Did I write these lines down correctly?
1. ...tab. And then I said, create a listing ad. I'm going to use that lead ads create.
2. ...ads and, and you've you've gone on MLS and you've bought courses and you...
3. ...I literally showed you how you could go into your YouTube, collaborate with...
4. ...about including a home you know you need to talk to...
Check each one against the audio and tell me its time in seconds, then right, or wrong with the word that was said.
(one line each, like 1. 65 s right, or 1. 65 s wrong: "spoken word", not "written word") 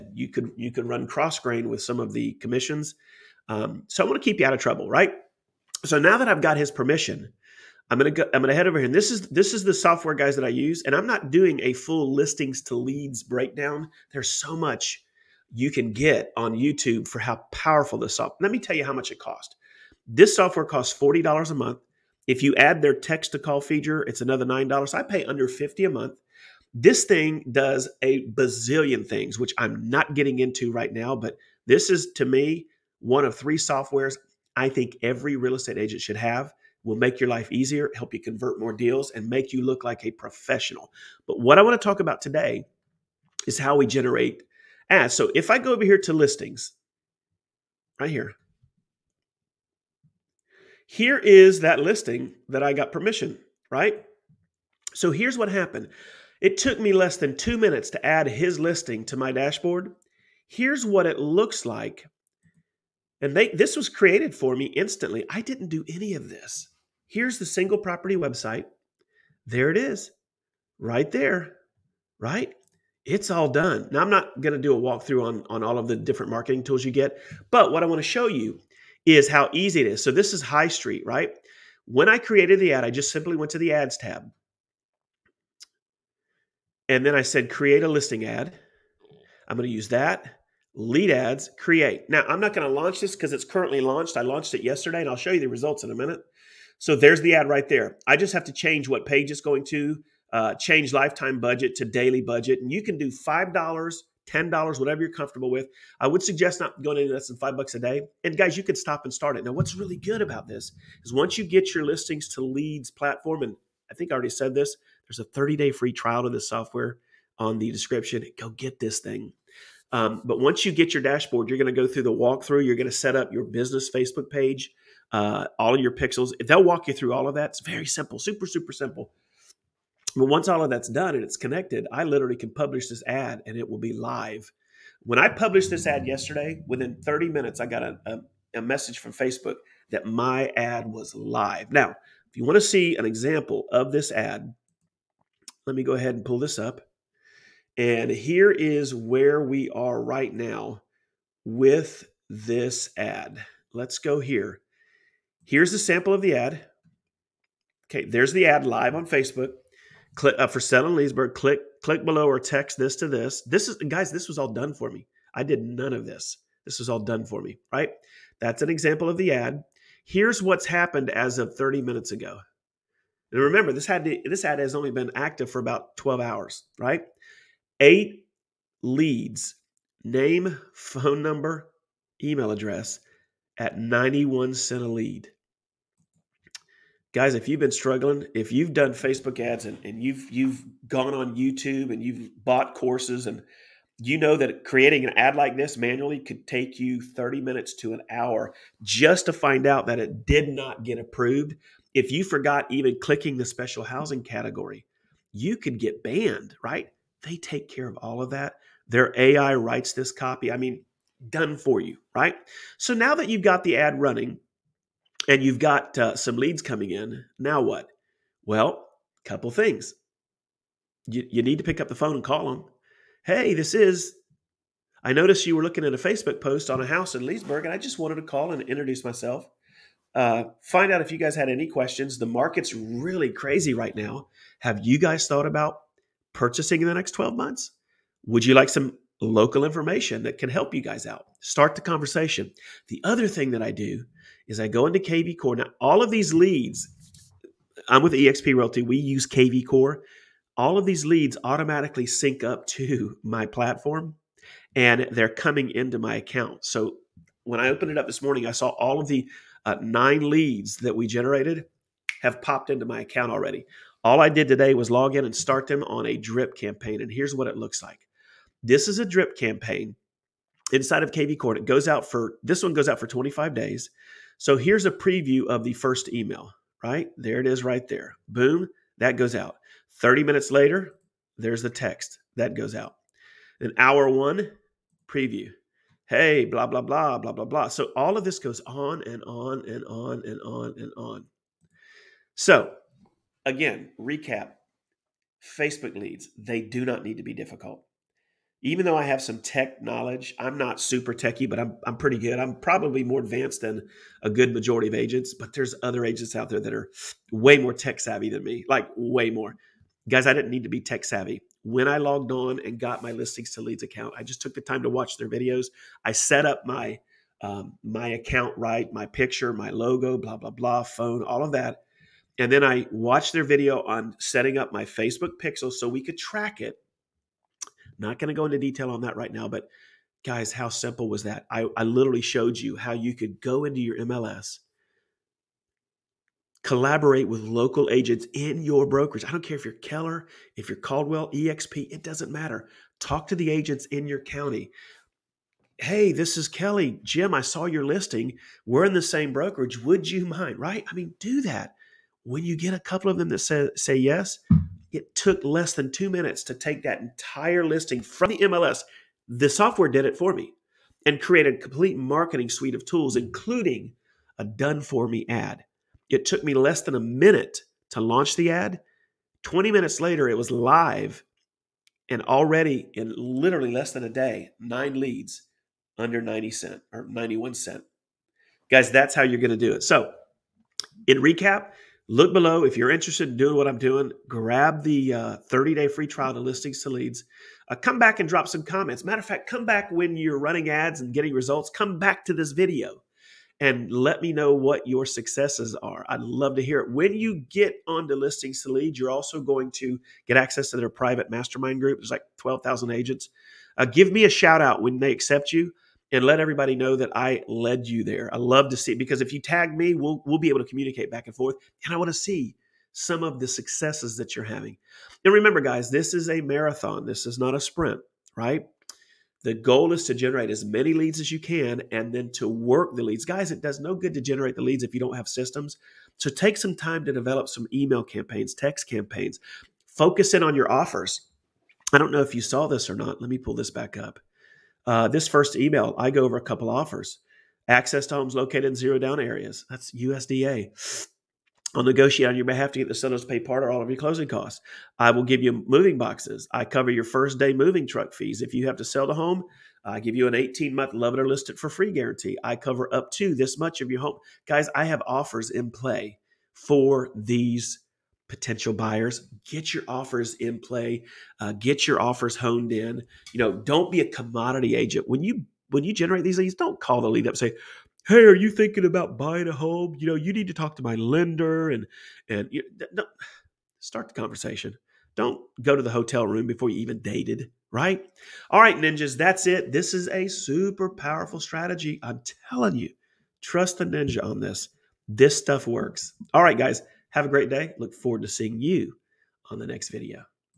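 1. 83 s right
2. 189 s wrong: "YouTube", not "MLS"
3. 331 s wrong: "MLS", not "YouTube"
4. 468 s wrong: "buying", not "including".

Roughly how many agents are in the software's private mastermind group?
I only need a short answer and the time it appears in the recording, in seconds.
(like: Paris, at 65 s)
12,000, at 402 s.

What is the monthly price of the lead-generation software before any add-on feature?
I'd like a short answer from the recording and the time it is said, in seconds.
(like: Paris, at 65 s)
$40, at 20 s.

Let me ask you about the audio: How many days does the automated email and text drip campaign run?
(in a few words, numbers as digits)
25 days.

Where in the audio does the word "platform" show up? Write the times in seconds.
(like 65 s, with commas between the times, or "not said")
112 s, 253 s.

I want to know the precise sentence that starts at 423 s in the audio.
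Guys, it does no good to generate the leads if you don't have systems.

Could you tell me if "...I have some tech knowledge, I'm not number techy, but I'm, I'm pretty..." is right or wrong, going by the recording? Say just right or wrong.
wrong.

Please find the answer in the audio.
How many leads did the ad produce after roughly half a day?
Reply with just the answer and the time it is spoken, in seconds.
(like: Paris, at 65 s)
8, at 177 s.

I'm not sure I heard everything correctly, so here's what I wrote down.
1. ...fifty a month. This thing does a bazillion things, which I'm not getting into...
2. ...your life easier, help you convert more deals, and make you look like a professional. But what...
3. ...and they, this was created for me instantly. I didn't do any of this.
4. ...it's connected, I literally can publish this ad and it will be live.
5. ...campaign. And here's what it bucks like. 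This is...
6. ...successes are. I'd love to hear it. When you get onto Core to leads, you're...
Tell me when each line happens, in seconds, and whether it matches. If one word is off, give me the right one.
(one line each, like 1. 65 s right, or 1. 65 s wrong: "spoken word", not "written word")
1. 25 s right
2. 37 s right
3. 63 s right
4. 131 s right
5. 266 s wrong: "looks", not "bucks"
6. 395 s wrong: "Listings", not "Core".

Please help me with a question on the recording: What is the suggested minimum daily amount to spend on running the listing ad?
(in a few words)
$5.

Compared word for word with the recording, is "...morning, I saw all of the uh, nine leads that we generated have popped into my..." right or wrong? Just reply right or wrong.
right.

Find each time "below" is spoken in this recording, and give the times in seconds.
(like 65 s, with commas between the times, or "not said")
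162 s, 382 s.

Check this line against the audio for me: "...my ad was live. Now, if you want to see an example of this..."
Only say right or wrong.
right.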